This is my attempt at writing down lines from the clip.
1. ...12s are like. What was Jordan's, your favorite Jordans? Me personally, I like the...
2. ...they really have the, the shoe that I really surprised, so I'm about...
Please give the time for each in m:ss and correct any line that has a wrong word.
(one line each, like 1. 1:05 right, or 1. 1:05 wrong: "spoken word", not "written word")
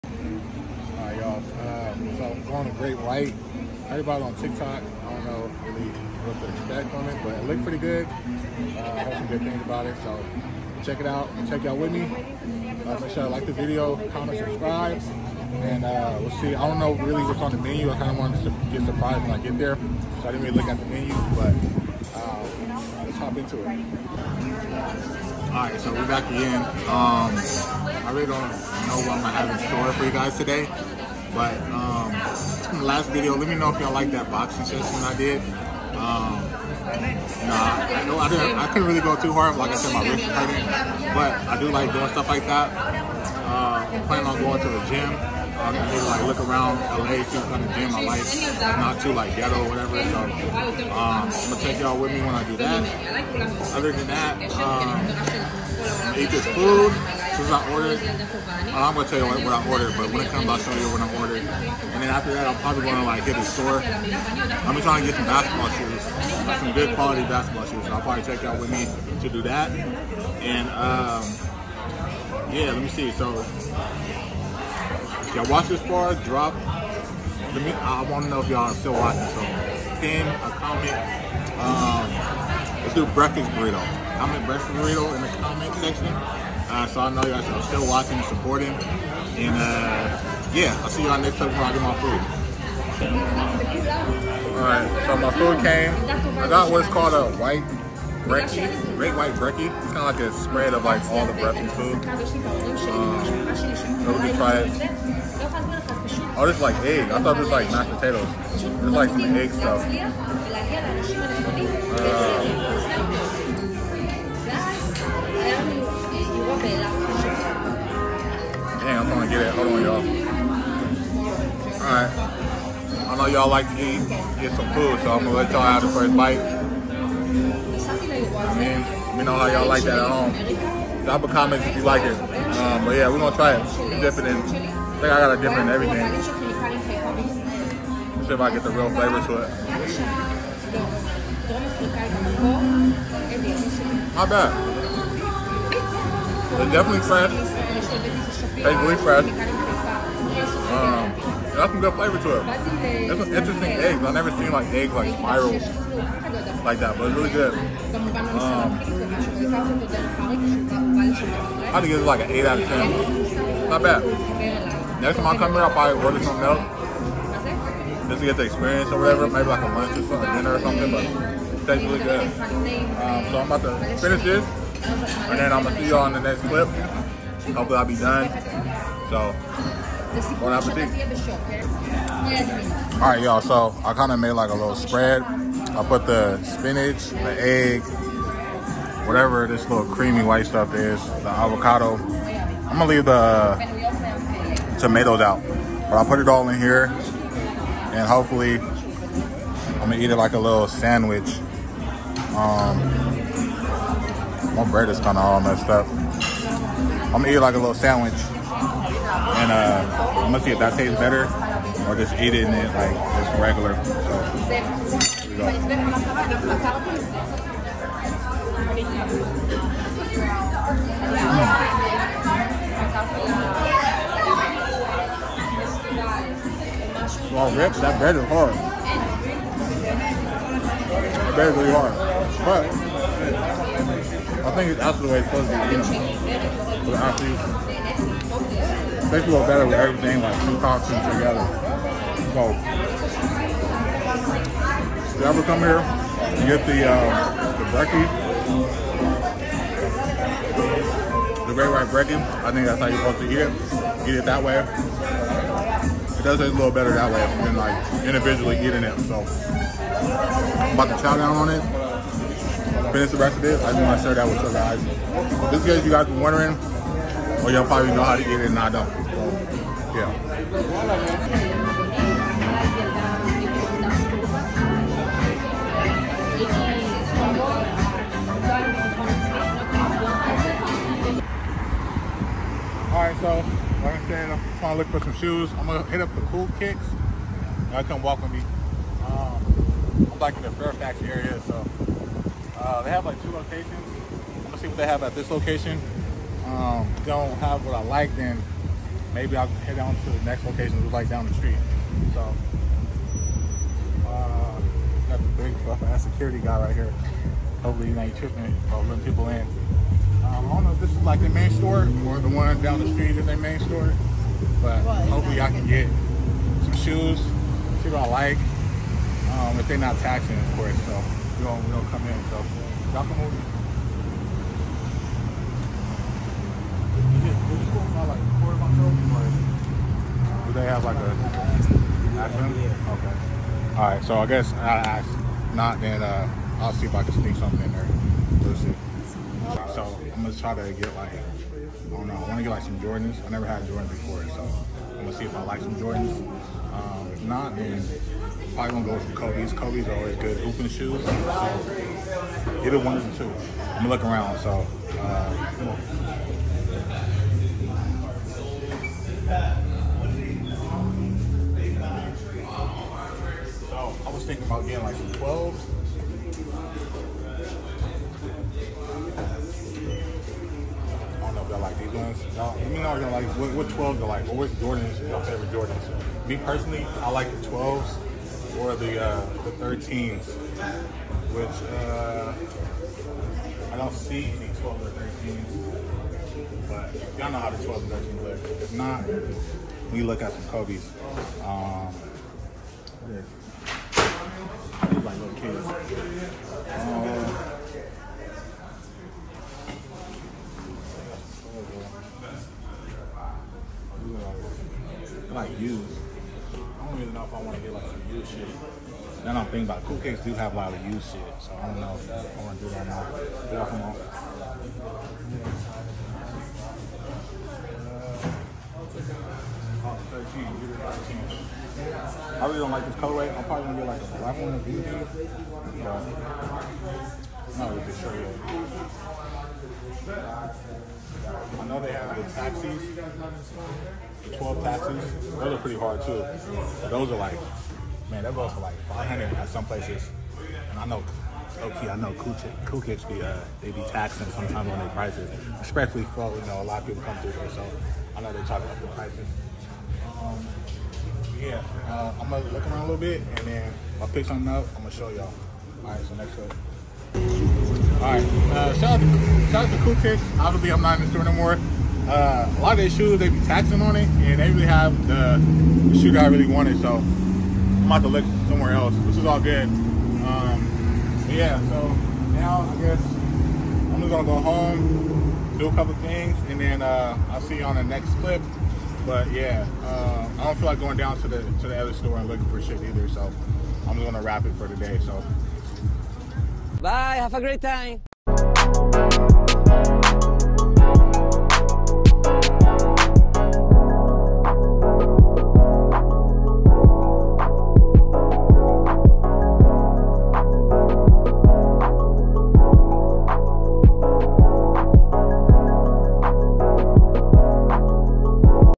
1. 6:13 right
2. 7:44 wrong: "wanted", not "surprised".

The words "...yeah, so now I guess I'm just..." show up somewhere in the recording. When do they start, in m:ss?
7:51.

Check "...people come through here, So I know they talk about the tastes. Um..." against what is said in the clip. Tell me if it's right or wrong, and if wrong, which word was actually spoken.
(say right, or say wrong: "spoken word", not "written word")
wrong: "prices", not "tastes".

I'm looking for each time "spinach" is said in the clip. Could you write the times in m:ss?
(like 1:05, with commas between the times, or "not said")
3:06.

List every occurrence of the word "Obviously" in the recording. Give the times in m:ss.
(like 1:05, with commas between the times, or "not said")
7:40.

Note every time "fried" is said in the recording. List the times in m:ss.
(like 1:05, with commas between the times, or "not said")
2:28.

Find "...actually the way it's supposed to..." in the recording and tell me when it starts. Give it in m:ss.
3:54.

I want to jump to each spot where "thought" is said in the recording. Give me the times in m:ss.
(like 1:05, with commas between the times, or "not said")
1:47.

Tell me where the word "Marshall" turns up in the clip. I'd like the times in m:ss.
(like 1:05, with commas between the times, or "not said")
not said.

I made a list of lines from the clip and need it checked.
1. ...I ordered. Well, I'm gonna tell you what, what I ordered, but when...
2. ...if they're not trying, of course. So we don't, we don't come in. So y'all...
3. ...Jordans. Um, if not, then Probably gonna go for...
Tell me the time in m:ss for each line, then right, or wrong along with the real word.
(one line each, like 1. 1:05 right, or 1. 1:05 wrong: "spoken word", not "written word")
1. 0:57 right
2. 5:19 wrong: "taxing", not "trying"
3. 5:45 right.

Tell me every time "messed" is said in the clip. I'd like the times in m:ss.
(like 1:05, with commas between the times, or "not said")
3:25.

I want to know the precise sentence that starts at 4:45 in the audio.
I'm gonna hit up the Cool Kicks.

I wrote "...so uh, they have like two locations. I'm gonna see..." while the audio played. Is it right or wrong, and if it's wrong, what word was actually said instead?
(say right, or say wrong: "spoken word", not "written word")
right.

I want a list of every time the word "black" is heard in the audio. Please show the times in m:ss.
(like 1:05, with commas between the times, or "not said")
7:04.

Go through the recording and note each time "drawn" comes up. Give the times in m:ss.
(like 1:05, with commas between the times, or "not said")
not said.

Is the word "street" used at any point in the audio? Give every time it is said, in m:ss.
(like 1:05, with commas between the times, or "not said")
5:01, 5:12.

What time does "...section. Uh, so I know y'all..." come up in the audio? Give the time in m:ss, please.
1:25.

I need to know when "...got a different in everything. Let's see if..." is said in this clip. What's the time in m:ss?
2:15.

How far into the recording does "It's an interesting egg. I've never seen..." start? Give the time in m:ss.
2:33.